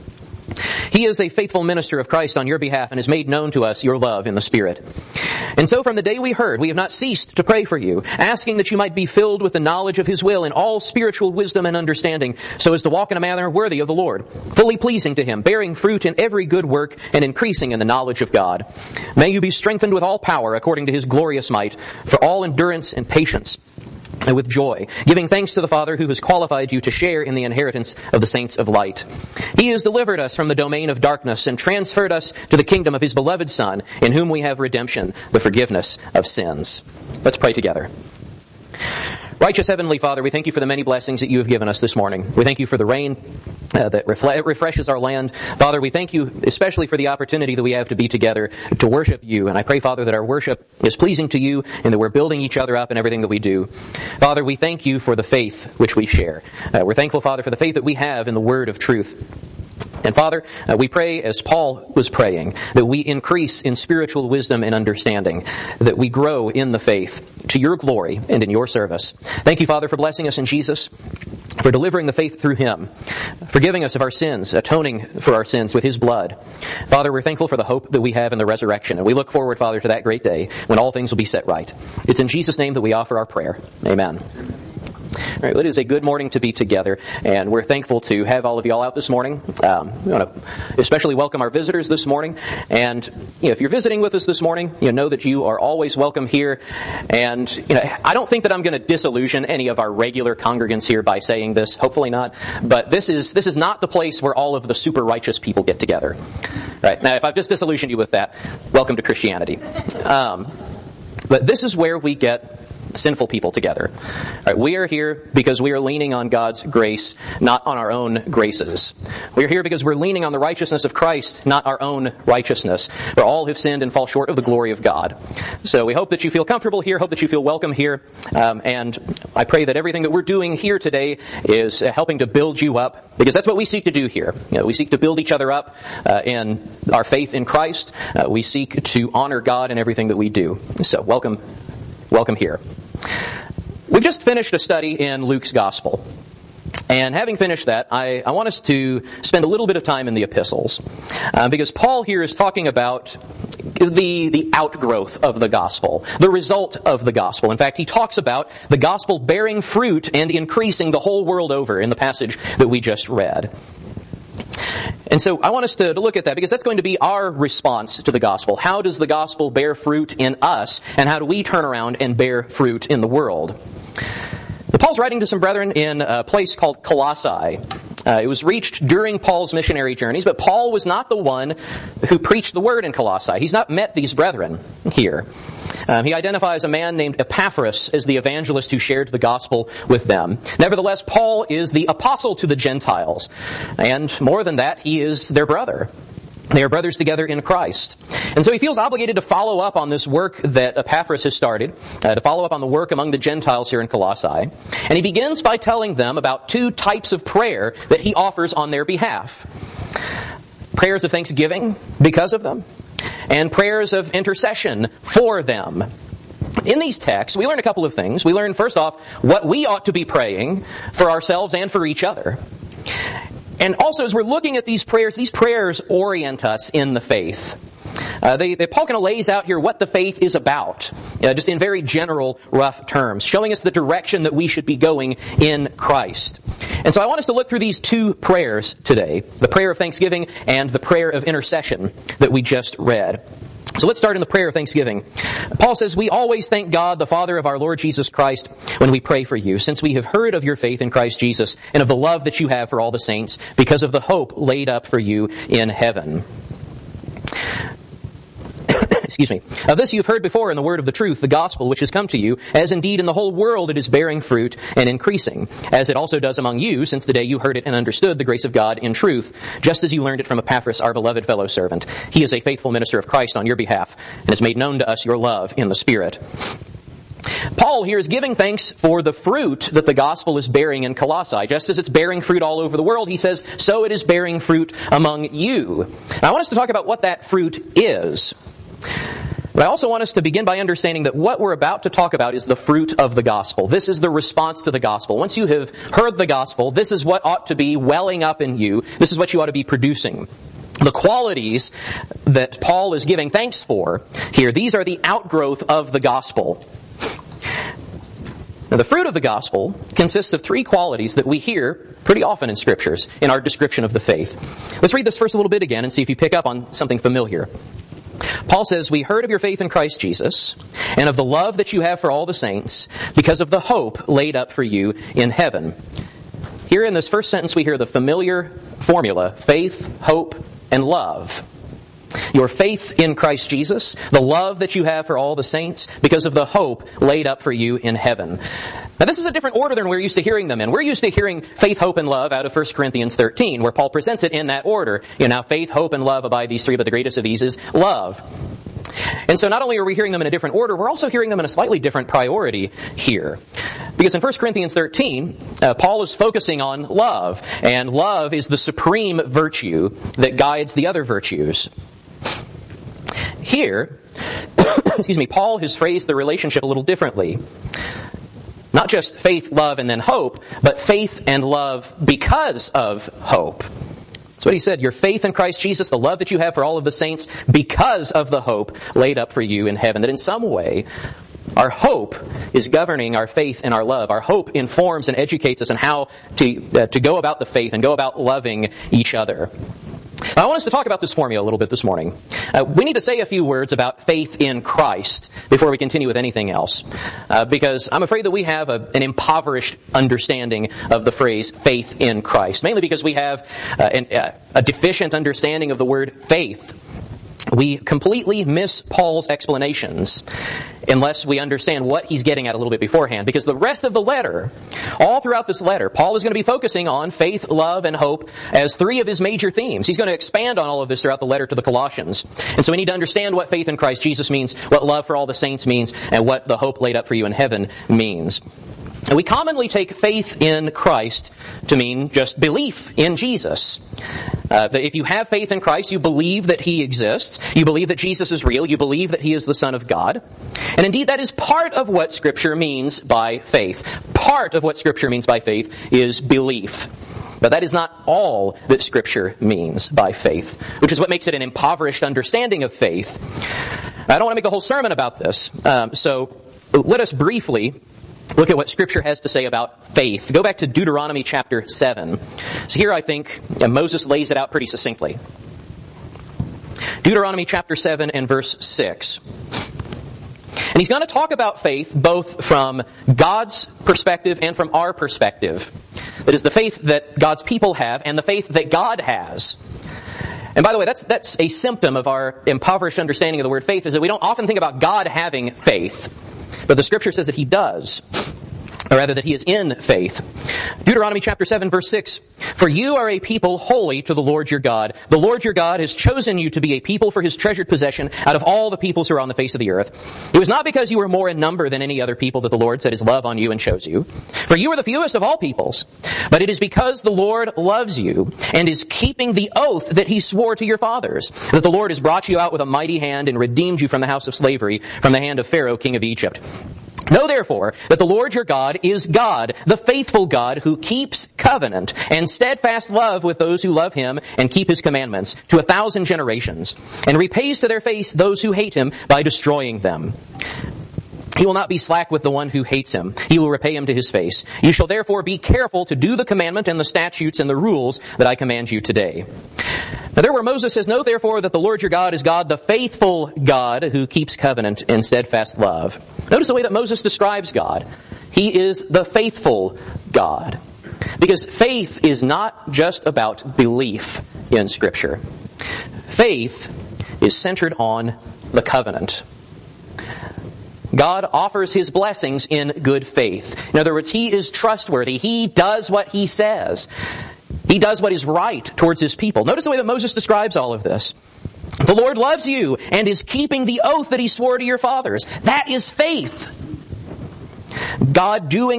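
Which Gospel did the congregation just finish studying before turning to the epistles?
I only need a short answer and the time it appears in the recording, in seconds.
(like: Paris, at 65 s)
Luke, at 145 s.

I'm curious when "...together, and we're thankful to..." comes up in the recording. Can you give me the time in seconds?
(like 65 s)
86 s.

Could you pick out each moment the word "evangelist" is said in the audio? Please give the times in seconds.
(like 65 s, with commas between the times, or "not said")
188 s.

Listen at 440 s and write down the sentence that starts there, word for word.
And indeed, that is part of what Scripture means by faith.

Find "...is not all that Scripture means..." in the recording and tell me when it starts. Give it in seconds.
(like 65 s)
447 s.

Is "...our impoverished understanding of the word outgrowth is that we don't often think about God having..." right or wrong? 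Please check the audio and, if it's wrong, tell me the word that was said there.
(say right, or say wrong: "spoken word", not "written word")
wrong: "faith", not "outgrowth".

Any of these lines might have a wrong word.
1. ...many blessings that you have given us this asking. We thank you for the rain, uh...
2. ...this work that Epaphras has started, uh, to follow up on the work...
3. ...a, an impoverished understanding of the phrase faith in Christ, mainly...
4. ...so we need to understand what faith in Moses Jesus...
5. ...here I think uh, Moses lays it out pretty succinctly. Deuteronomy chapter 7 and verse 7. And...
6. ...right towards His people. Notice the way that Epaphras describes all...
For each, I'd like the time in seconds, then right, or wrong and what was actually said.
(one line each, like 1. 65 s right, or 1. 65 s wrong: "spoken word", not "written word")
1. 40 s wrong: "morning", not "asking"
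2. 199 s right
3. 398 s right
4. 422 s wrong: "Christ", not "Moses"
5. 462 s wrong: "6", not "7"
6. 568 s wrong: "Moses", not "Epaphras".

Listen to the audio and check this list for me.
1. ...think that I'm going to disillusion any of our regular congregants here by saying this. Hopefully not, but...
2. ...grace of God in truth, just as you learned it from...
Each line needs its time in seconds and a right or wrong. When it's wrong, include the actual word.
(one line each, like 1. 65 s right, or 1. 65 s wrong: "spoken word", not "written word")
1. 98 s right
2. 268 s right.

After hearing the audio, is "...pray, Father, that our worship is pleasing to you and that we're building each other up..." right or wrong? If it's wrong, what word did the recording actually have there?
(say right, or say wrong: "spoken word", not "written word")
right.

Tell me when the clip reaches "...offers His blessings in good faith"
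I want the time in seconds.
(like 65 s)
561 s.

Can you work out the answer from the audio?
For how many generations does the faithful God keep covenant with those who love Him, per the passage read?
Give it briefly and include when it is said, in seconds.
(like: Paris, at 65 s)
1,000, at 525 s.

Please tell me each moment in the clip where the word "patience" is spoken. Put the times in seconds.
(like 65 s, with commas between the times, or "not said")
23 s.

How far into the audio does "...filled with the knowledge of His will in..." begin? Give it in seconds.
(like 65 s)
9 s.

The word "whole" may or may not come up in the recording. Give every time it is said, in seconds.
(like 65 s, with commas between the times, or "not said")
160 s, 263 s, 454 s.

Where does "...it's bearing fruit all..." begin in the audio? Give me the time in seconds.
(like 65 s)
281 s.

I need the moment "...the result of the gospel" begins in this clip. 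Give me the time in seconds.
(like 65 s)
156 s.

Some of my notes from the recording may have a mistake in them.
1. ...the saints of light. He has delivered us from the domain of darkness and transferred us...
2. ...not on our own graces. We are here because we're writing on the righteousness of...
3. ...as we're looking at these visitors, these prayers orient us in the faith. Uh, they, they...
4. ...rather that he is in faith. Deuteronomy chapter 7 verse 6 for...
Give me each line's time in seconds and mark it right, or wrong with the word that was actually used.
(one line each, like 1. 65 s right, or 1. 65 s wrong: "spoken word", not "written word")
1. 28 s right
2. 117 s wrong: "leaning", not "writing"
3. 224 s wrong: "prayers", not "visitors"
4. 488 s right.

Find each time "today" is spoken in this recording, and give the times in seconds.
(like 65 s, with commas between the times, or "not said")
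130 s, 238 s, 538 s.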